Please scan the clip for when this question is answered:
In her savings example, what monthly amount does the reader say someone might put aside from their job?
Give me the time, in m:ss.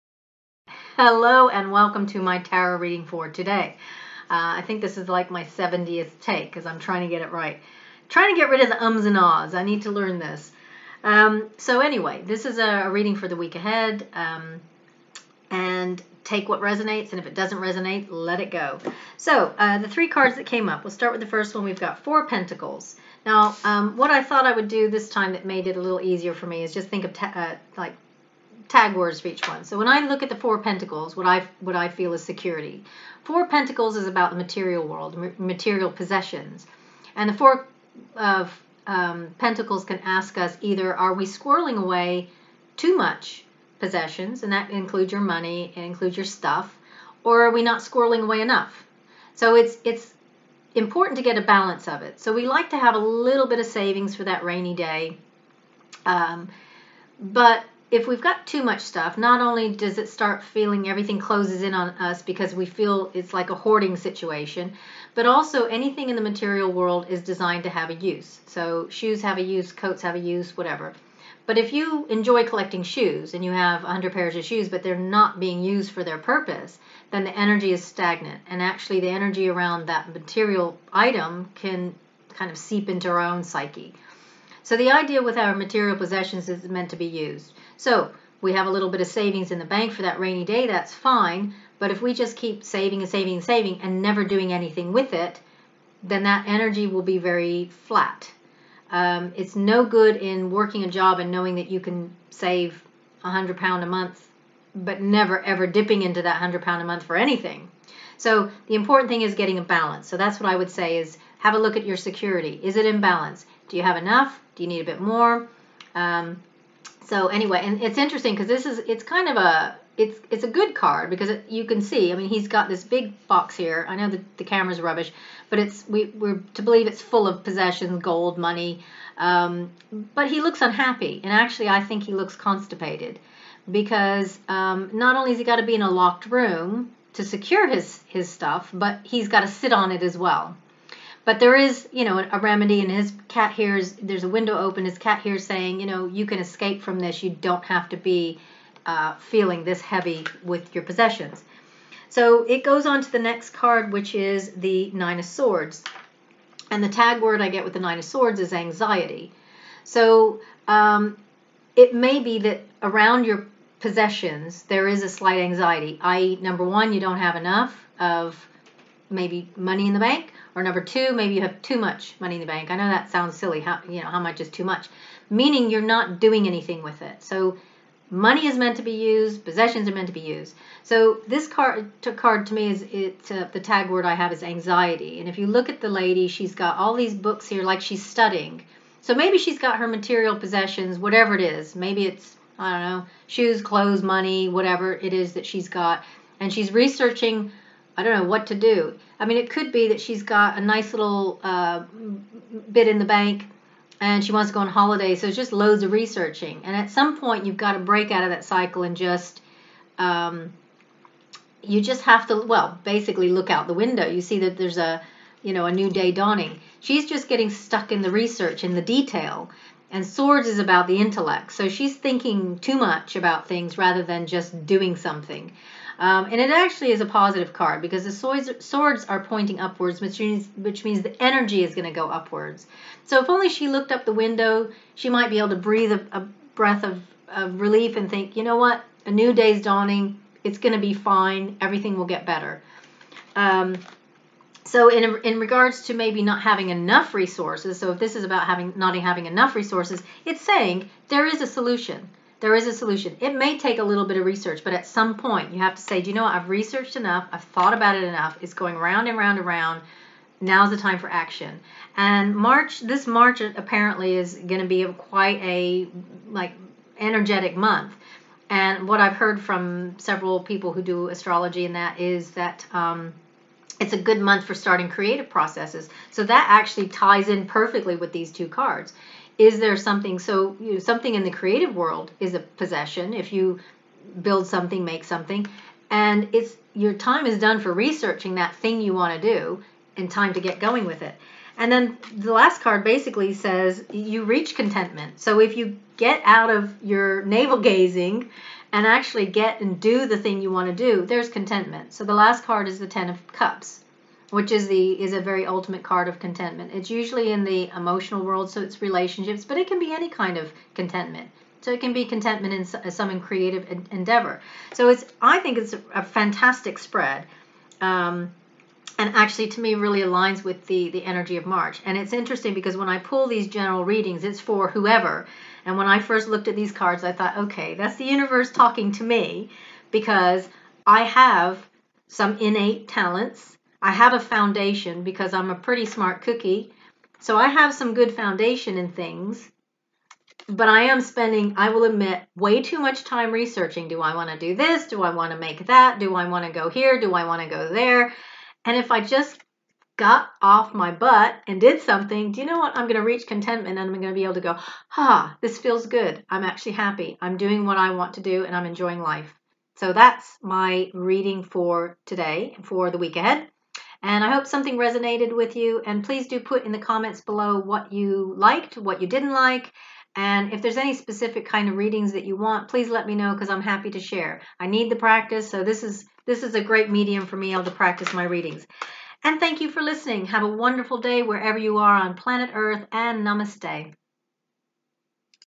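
1:43.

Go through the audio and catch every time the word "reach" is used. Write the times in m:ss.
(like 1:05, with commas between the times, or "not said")
4:54, 5:53.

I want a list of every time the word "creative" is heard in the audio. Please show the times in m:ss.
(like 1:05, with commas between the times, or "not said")
4:34, 4:41, 5:13.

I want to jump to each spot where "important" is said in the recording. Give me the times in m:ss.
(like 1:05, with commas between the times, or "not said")
0:50, 1:48.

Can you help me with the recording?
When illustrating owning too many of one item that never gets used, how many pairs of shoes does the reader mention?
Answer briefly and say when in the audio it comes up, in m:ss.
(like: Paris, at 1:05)
100, at 1:13.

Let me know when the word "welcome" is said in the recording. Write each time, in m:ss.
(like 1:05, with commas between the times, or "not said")
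0:01.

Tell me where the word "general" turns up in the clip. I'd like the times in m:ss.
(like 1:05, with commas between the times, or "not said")
5:23.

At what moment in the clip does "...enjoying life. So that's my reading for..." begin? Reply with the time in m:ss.
5:58.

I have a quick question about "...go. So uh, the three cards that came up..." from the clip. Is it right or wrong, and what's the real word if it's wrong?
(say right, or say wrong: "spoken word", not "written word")
right.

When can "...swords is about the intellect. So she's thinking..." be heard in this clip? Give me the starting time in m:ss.
3:40.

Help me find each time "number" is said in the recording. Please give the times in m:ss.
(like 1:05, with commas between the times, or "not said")
2:46, 2:50.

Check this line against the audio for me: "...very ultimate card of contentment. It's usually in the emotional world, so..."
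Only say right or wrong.
right.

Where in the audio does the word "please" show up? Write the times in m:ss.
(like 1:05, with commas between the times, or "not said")
6:06, 6:12.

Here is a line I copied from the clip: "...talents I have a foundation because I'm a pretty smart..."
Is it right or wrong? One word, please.
right.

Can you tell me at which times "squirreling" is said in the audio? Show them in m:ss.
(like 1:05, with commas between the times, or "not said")
0:41, 0:47.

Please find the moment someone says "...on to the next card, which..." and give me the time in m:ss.
2:32.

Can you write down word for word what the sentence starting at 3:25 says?
So it's just loads of researching.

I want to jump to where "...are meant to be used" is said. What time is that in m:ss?
2:59.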